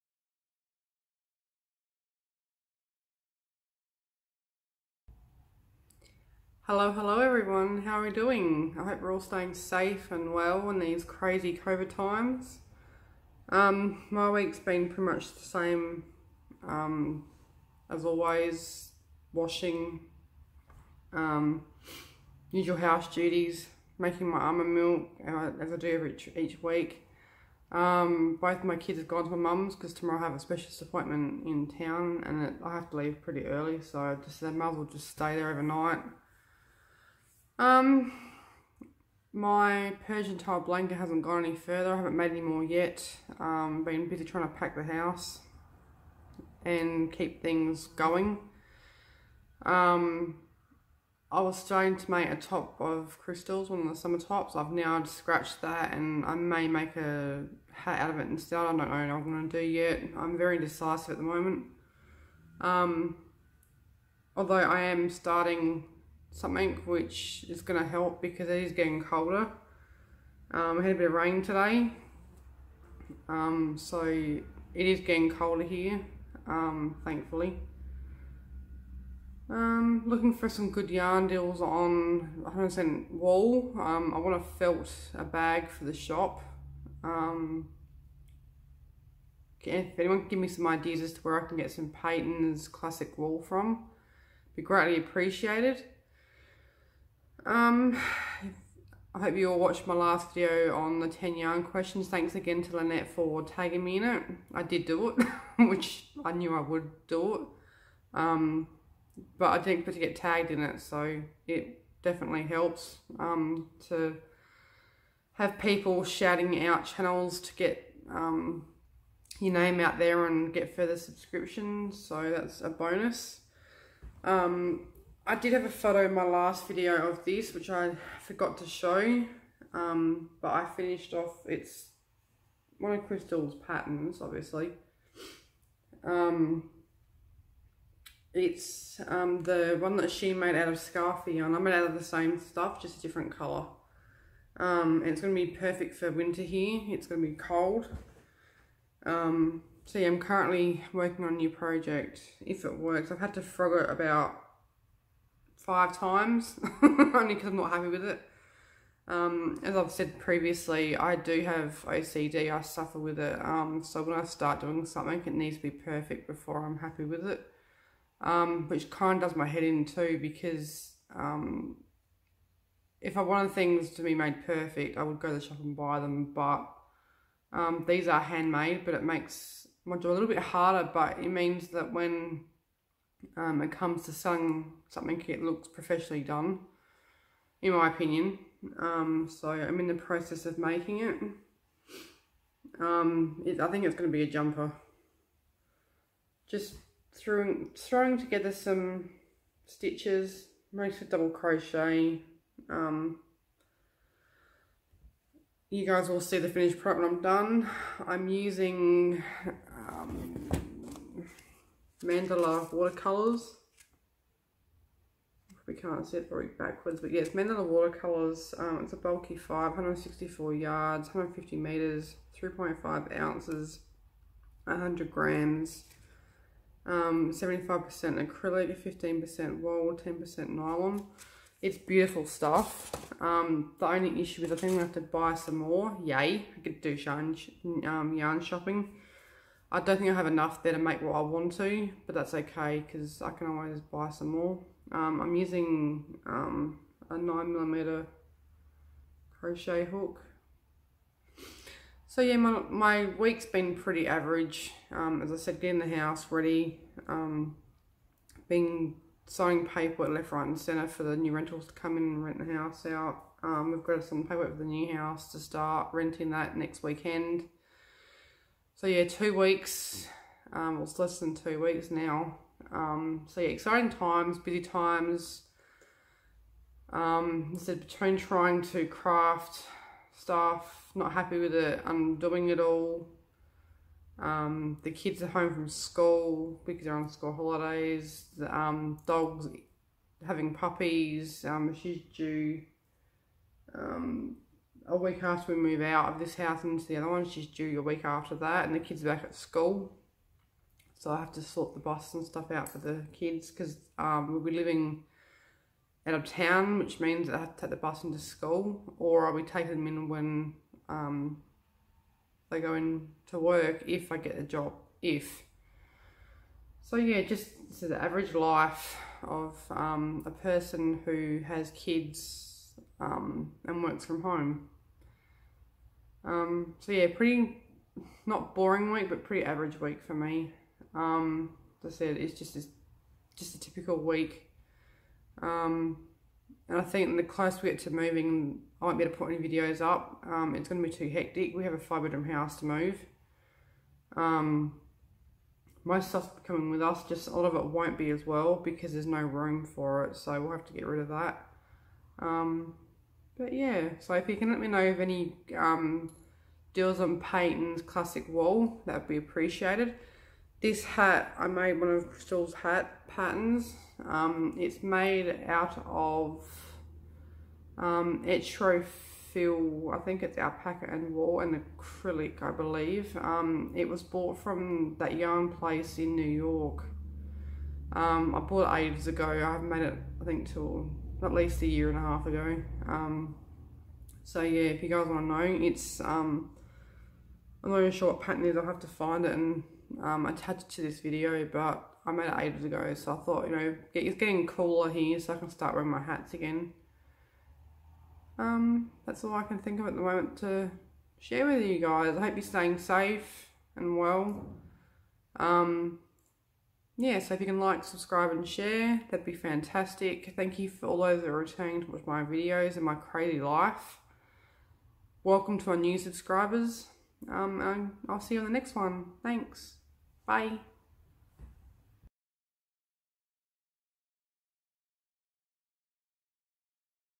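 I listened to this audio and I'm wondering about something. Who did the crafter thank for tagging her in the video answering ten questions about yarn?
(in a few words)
Lynette.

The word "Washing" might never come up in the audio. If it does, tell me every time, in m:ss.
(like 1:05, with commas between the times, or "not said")
0:19.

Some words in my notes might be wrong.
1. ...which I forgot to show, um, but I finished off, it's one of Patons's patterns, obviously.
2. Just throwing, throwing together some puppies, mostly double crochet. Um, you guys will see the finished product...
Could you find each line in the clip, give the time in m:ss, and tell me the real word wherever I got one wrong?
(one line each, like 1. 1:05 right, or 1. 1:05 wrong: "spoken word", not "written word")
1. 2:07 wrong: "Crystal", not "Patons"
2. 3:16 wrong: "stitches", not "puppies".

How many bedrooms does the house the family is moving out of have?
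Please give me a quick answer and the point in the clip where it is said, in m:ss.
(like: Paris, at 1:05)
5, at 5:41.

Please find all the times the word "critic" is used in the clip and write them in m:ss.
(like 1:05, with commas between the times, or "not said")
not said.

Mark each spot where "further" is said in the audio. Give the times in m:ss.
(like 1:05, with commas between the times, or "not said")
0:41, 2:00.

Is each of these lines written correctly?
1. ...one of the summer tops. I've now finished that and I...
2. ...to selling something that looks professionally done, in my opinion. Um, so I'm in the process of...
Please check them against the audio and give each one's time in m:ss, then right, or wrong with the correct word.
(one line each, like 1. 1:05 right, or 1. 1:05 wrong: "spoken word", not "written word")
1. 0:53 wrong: "scratched", not "finished"
2. 3:04 right.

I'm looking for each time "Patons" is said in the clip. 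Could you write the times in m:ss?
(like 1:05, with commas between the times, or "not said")
1:31, 5:57.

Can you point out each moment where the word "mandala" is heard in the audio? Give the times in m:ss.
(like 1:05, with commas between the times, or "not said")
3:32, 3:37.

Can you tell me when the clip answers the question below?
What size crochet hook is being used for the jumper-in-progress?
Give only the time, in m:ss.
4:07.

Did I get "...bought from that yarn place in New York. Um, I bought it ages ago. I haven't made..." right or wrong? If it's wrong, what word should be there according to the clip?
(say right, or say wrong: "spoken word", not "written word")
right.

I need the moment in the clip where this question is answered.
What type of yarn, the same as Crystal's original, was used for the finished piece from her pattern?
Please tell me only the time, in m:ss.
2:20.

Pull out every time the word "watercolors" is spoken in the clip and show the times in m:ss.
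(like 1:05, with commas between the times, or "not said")
3:32, 3:37.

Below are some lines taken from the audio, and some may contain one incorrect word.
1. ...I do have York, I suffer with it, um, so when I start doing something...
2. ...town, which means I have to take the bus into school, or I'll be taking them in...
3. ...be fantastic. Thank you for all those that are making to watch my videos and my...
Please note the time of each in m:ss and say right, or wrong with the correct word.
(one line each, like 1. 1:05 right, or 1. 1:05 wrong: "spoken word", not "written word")
1. 2:40 wrong: "OCD", not "York"
2. 5:06 right
3. 6:49 wrong: "returning", not "making".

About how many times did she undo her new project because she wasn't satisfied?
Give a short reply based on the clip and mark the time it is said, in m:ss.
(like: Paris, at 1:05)
5, at 2:33.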